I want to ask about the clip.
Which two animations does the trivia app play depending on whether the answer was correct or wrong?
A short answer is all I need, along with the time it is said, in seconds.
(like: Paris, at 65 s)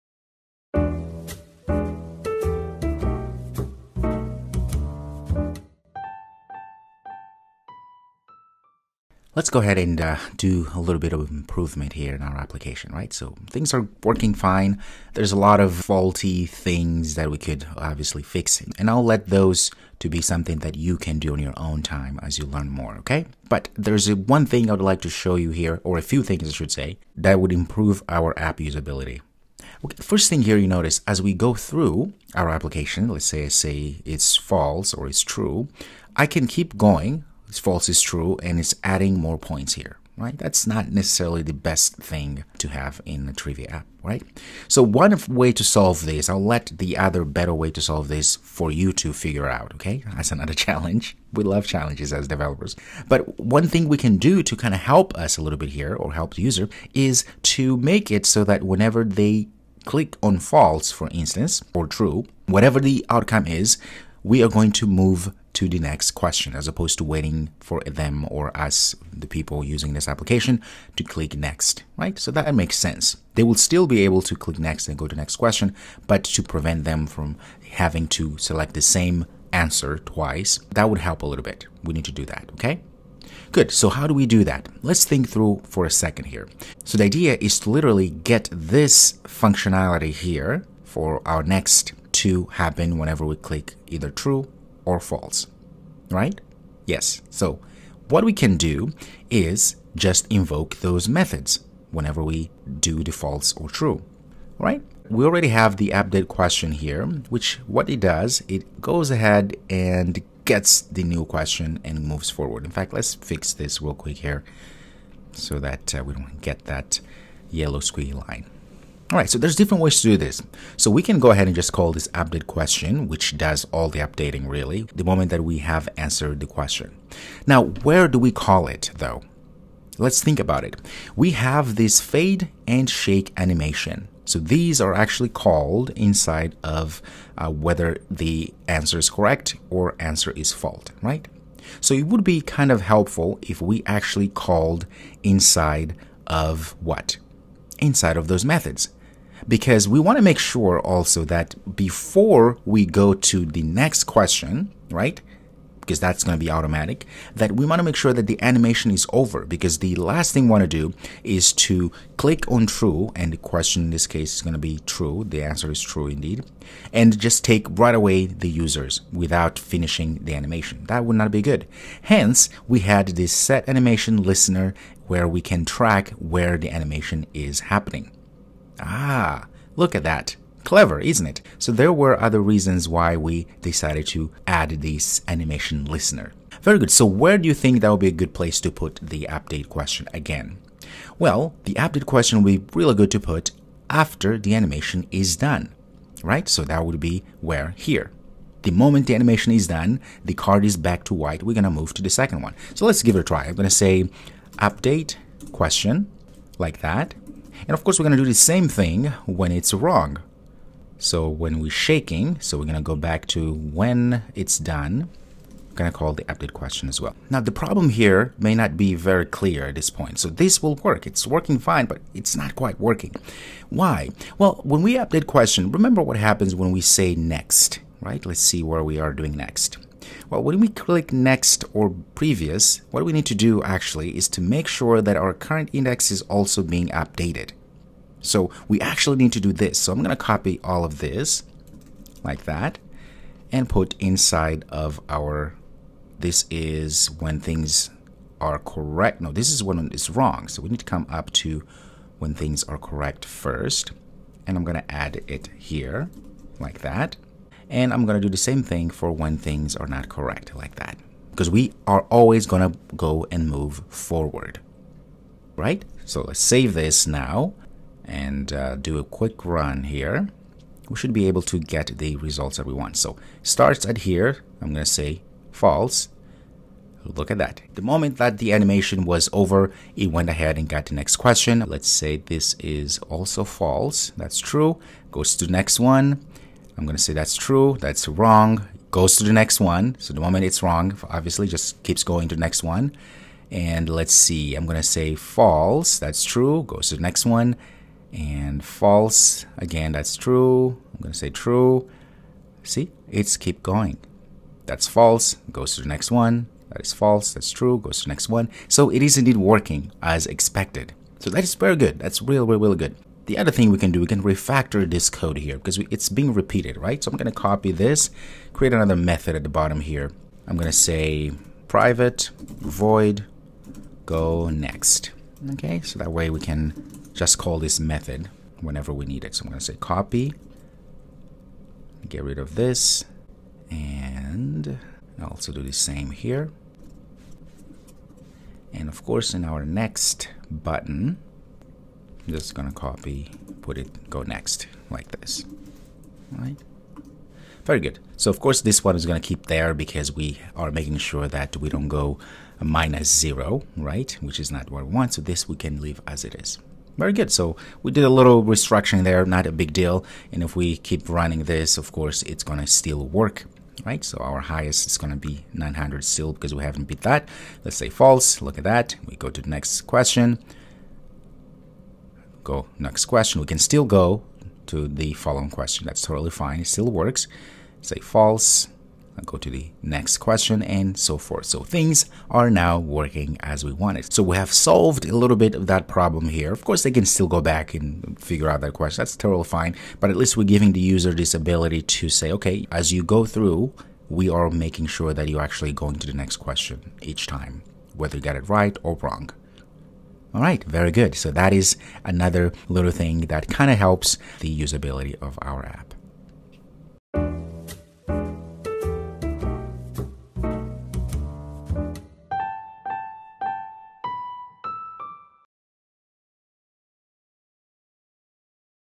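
fade and shake, at 131 s.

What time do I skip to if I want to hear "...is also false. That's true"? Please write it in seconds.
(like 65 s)
282 s.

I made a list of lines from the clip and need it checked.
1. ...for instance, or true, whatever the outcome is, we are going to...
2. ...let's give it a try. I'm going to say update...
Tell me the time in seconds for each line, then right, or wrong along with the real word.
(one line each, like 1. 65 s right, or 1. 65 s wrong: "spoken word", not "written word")
1. 60 s right
2. 202 s right.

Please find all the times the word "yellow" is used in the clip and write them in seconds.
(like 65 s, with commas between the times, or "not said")
117 s.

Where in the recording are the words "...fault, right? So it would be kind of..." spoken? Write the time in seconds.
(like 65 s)
140 s.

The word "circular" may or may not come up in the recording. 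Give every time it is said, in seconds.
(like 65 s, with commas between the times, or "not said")
not said.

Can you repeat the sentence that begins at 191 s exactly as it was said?
Well, the update question would be really good to put after the animation is done, right?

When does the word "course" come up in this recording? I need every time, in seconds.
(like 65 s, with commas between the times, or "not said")
207 s, 339 s, 348 s, 361 s, 386 s.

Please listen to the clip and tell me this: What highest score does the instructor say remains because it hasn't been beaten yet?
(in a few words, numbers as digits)
900.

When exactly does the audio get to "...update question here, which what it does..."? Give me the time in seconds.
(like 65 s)
105 s.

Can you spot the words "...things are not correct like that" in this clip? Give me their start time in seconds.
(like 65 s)
259 s.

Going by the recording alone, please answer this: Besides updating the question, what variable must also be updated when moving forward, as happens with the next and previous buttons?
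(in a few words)
current index.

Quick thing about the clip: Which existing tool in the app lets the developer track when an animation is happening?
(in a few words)
set animation listener.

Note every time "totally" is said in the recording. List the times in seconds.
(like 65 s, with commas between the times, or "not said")
376 s, 389 s.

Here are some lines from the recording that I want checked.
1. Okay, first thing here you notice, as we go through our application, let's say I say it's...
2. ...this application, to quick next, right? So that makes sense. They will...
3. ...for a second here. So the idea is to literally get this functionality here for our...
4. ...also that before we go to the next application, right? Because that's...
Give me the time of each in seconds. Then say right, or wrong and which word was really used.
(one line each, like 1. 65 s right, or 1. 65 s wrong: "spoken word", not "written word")
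1. 29 s right
2. 69 s wrong: "click", not "quick"
3. 85 s right
4. 150 s wrong: "question", not "application".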